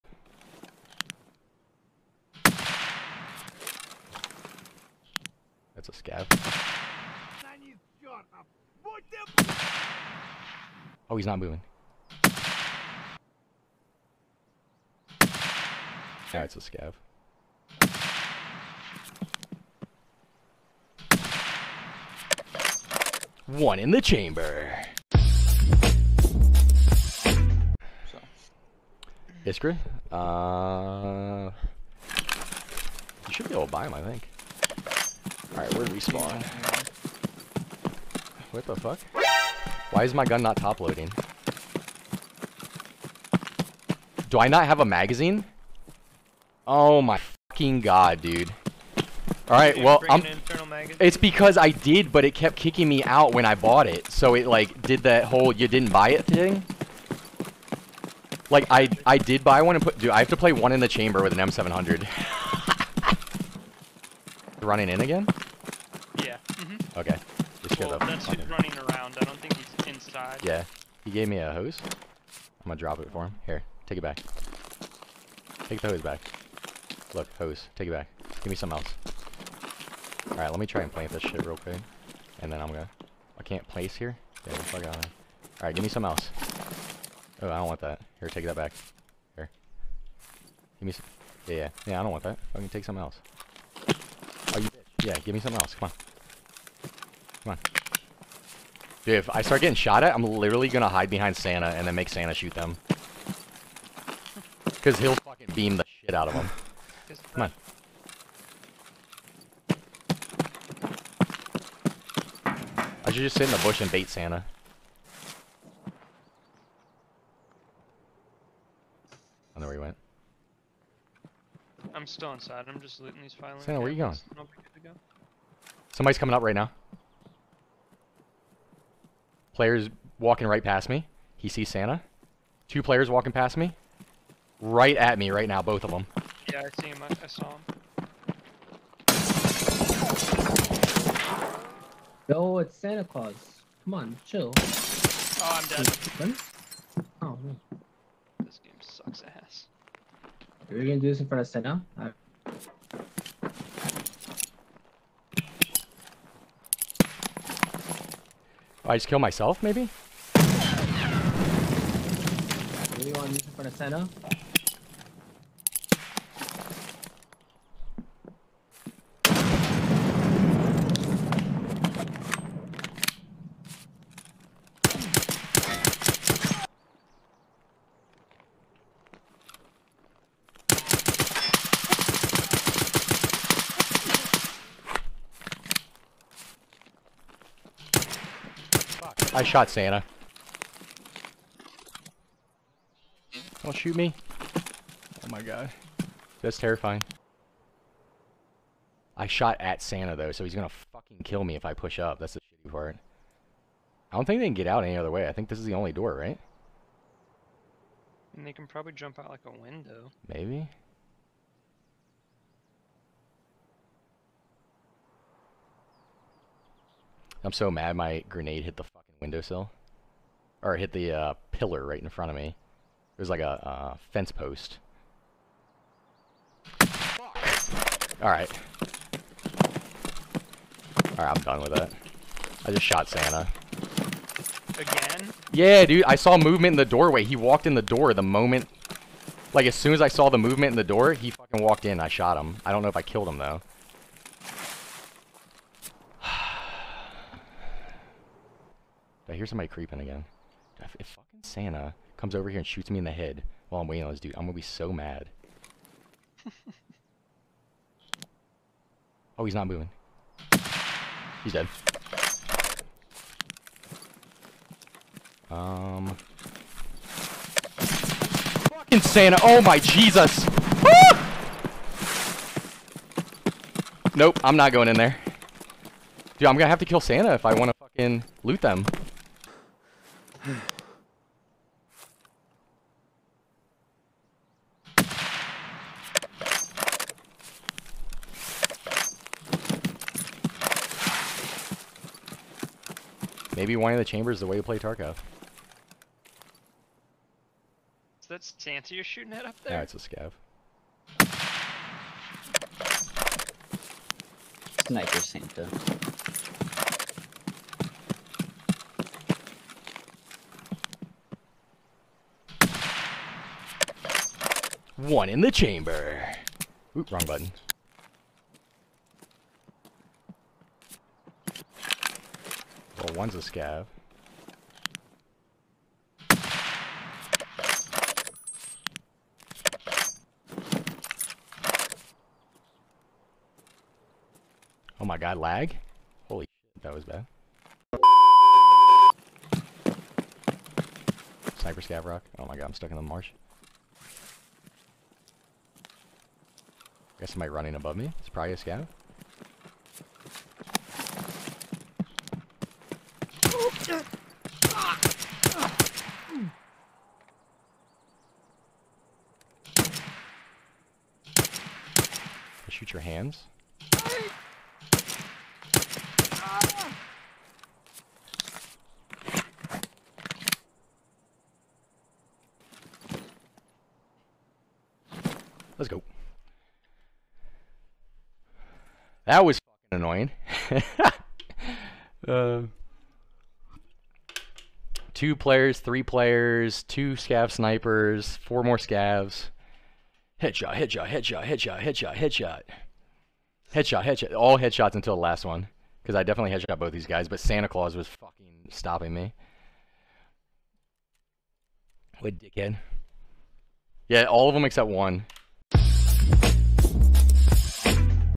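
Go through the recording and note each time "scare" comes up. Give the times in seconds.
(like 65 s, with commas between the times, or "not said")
not said.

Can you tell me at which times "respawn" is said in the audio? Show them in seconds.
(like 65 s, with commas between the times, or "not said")
35 s.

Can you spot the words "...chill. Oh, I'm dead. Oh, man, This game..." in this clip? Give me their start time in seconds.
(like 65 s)
144 s.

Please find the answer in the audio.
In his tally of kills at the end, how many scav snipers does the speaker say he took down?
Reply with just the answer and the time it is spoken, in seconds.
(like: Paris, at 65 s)
2, at 386 s.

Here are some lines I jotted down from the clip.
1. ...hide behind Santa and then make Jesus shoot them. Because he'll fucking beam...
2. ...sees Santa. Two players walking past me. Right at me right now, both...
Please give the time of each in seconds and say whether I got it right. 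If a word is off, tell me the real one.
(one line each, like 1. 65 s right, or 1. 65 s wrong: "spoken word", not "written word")
1. 100 s wrong: "Santa", not "Jesus"
2. 131 s right.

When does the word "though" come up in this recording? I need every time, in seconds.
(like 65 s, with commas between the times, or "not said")
200 s, 243 s.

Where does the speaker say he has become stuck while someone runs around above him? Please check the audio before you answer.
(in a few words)
the marsh.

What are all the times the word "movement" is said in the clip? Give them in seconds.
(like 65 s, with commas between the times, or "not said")
236 s, 240 s.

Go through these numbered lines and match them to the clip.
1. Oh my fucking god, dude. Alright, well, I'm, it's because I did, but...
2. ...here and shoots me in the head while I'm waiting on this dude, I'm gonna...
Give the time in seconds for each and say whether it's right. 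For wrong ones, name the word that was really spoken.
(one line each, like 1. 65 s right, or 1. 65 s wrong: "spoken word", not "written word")
1. 46 s right
2. 252 s right.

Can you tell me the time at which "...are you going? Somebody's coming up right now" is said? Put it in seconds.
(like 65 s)
123 s.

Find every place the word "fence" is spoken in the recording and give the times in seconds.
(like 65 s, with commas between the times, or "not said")
224 s.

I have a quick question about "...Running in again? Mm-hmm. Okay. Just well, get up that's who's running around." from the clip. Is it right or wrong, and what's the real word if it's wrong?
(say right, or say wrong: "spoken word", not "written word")
right.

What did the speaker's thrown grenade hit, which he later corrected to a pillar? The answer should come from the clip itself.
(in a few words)
windowsill.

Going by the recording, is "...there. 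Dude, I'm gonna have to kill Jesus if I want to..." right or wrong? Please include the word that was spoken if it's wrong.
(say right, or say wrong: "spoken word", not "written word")
wrong: "Santa", not "Jesus".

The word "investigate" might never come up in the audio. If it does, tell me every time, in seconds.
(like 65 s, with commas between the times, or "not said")
not said.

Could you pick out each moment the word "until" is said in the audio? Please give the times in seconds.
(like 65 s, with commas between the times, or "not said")
394 s.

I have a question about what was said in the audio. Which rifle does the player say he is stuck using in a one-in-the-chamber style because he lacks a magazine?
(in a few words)
M700.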